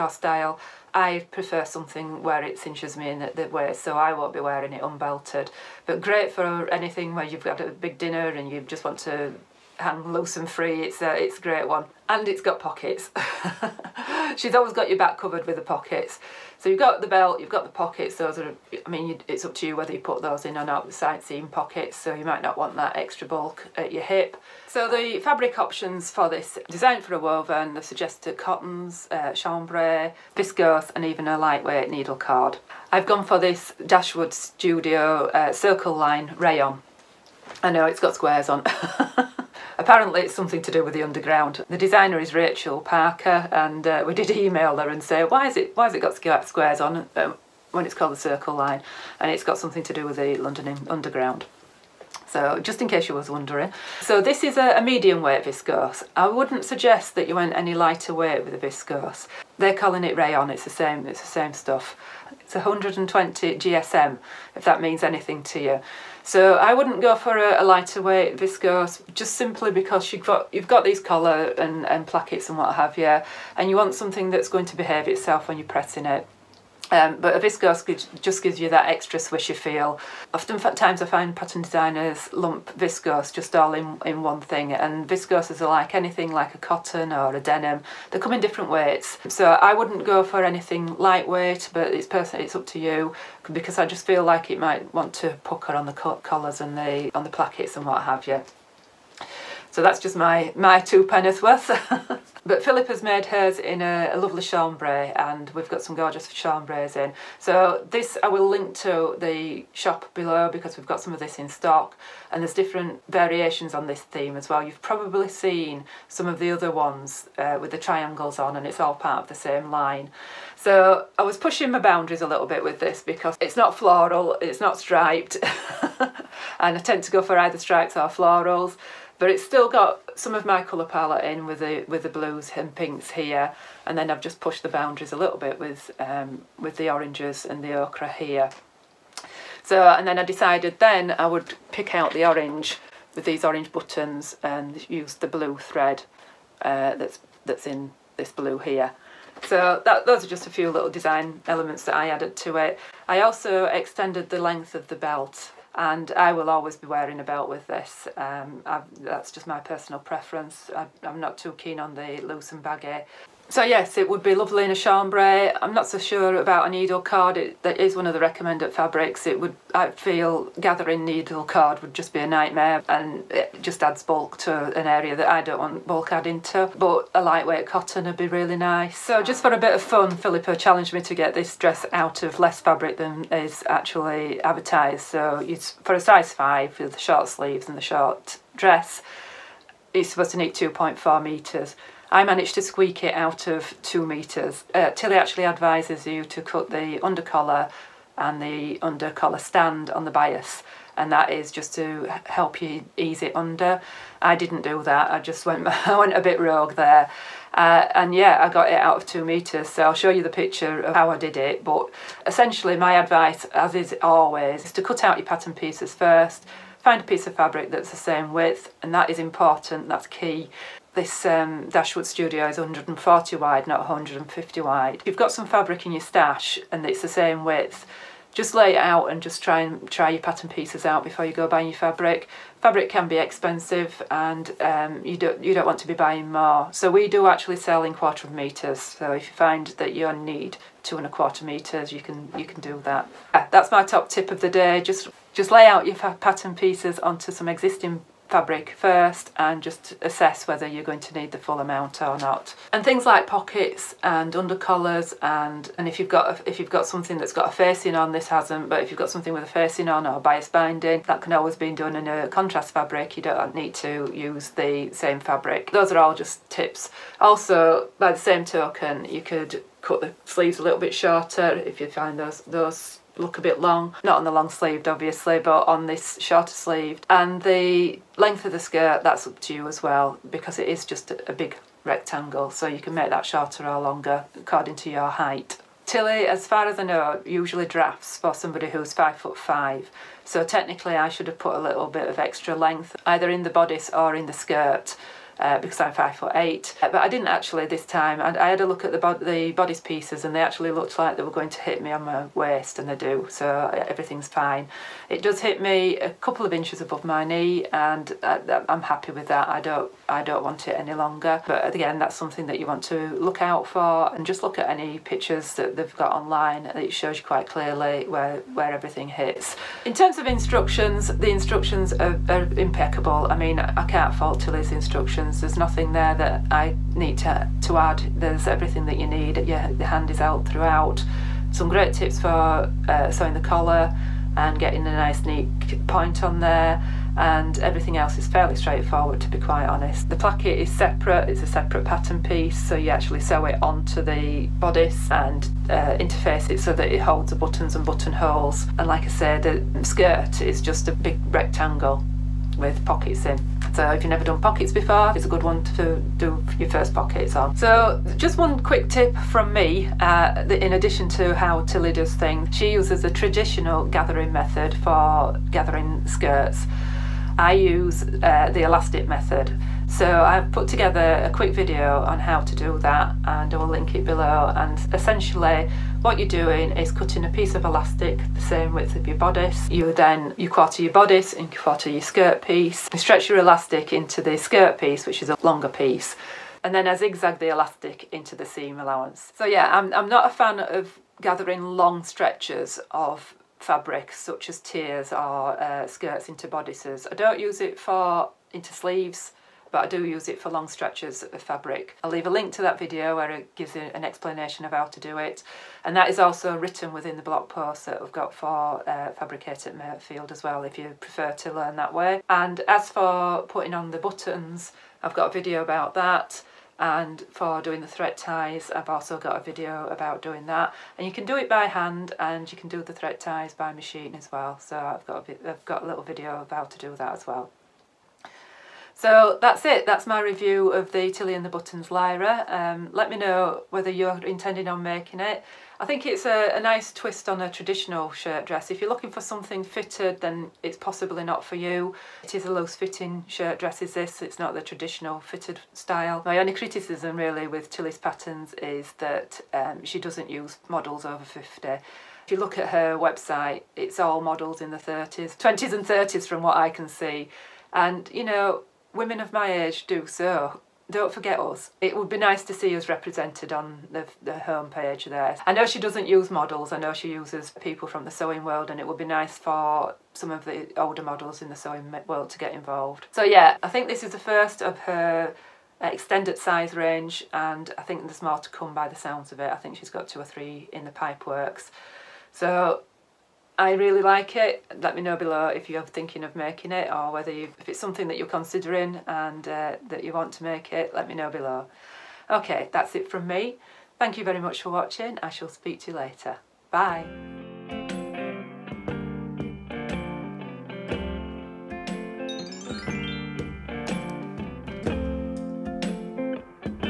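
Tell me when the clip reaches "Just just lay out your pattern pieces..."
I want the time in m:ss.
4:04.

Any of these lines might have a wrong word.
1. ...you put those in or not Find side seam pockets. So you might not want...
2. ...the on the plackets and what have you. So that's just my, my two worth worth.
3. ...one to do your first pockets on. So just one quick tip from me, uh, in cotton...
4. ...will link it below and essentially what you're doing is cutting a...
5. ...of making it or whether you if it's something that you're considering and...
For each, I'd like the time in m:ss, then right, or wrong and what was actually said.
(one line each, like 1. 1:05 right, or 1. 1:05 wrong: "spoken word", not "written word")
1. 0:19 wrong: "The", not "Find"
2. 1:36 wrong: "penneth", not "worth"
3. 5:55 wrong: "addition", not "cotton"
4. 6:13 right
5. 8:06 right.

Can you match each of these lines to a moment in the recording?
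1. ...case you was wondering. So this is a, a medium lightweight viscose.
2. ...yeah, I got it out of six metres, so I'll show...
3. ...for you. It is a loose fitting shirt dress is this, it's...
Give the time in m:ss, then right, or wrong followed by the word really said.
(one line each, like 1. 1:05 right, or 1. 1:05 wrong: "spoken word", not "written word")
1. 0:52 wrong: "weight", not "lightweight"
2. 3:28 wrong: "two", not "six"
3. 7:21 right.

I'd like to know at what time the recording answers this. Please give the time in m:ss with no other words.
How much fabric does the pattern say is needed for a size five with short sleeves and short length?
3:10.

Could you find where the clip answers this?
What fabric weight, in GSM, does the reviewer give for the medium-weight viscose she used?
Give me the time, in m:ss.
1:02.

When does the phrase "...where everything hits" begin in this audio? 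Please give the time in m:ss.
5:18.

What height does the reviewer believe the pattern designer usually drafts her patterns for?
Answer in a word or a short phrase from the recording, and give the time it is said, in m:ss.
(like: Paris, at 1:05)
5 foot 5, at 4:48.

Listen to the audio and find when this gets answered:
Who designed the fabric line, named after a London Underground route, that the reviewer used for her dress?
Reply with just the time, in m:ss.
0:42.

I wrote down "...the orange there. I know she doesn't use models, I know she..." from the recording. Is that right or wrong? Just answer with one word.
wrong.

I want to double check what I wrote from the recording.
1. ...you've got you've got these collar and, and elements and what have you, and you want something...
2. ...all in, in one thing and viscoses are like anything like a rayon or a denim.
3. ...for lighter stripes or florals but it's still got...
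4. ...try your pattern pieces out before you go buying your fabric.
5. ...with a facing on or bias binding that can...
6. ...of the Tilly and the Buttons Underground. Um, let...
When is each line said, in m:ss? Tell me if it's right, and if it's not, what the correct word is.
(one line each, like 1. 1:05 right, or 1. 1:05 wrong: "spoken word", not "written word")
1. 1:10 wrong: "plackets", not "elements"
2. 1:23 wrong: "cotton", not "rayon"
3. 2:07 wrong: "either", not "lighter"
4. 3:49 right
5. 4:19 right
6. 7:10 wrong: "Lyra", not "Underground".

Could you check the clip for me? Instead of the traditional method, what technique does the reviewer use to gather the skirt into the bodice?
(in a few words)
elastic method.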